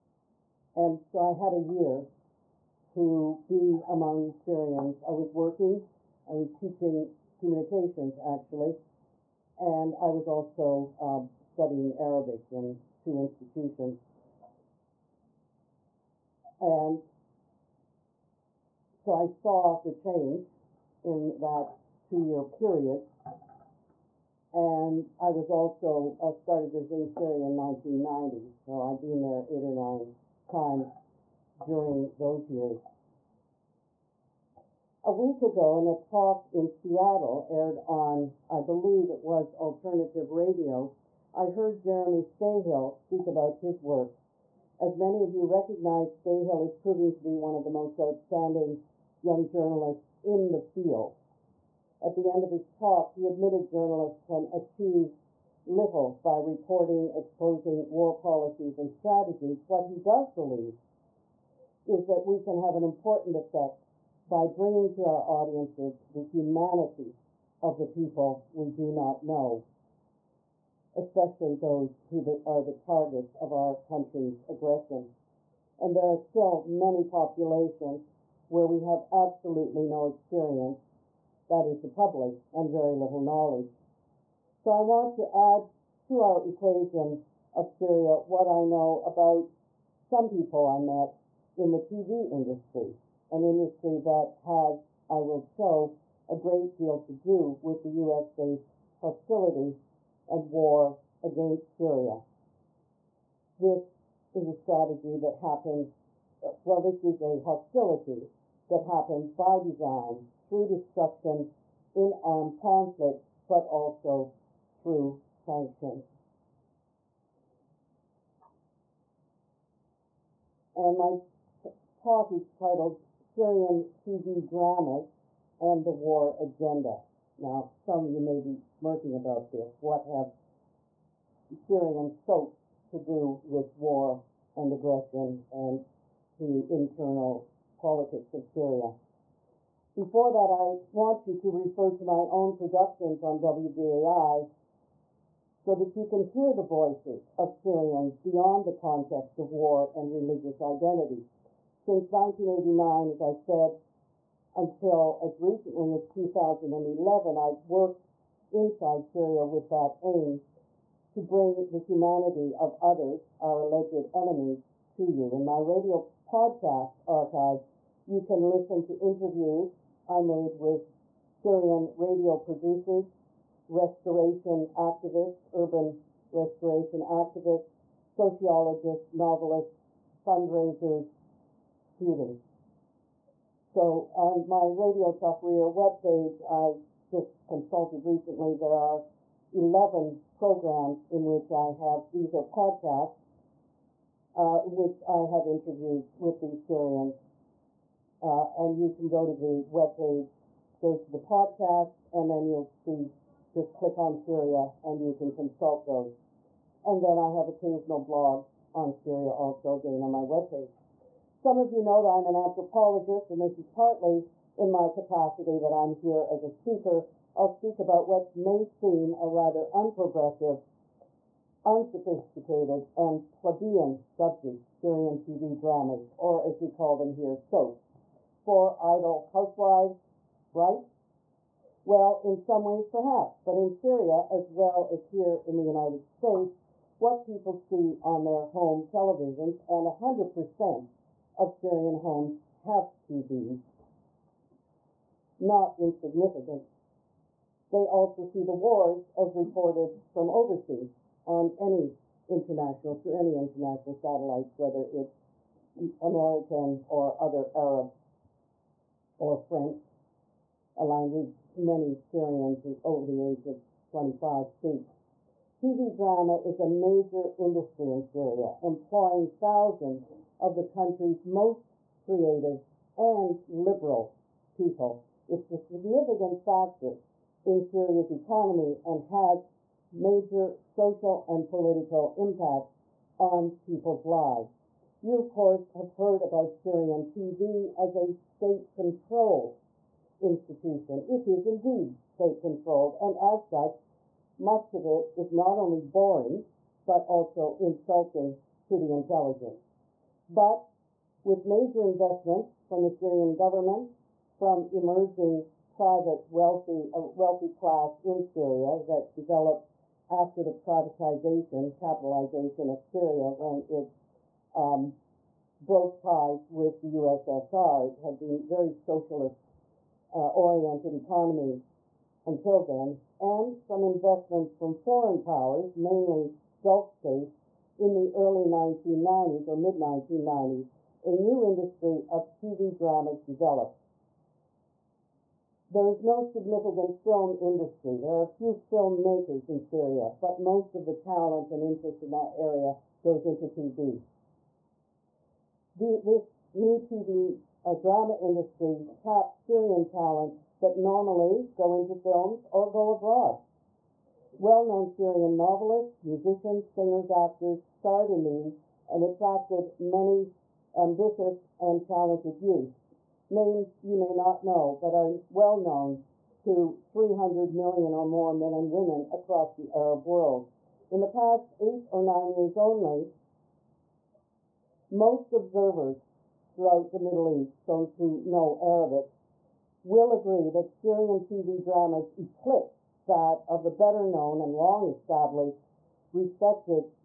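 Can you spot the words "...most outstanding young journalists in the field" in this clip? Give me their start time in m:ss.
0:47.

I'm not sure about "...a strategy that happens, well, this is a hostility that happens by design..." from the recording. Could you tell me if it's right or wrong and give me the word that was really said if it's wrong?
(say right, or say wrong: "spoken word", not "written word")
right.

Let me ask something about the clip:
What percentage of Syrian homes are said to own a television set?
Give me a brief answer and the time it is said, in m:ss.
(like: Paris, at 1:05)
100%, at 3:59.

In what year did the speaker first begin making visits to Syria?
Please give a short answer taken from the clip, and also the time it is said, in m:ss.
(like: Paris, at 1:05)
1990, at 0:27.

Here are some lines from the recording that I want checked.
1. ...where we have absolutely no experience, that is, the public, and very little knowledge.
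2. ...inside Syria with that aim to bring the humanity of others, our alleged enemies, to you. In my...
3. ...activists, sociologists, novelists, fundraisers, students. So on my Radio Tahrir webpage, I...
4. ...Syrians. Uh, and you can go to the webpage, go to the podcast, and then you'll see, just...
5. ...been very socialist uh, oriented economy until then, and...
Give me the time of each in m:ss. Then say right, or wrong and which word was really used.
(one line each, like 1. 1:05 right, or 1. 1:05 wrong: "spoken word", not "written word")
1. 1:18 right
2. 2:38 right
3. 2:57 right
4. 3:16 right
5. 5:18 right.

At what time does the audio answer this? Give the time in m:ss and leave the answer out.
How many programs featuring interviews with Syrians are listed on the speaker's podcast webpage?
3:09.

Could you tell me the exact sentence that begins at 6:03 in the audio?
Names you may not know, but are well known to 300 million or more men and women across the Arab world.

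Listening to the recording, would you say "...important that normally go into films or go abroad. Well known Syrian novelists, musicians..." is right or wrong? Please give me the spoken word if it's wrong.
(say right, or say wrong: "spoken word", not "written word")
wrong: "talent", not "important".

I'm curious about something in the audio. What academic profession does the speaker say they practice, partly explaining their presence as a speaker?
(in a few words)
Anthropologist.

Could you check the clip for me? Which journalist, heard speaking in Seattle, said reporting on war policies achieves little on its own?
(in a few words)
Jeremy Scahill.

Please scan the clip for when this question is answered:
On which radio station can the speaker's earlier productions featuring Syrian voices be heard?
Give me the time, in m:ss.
2:23.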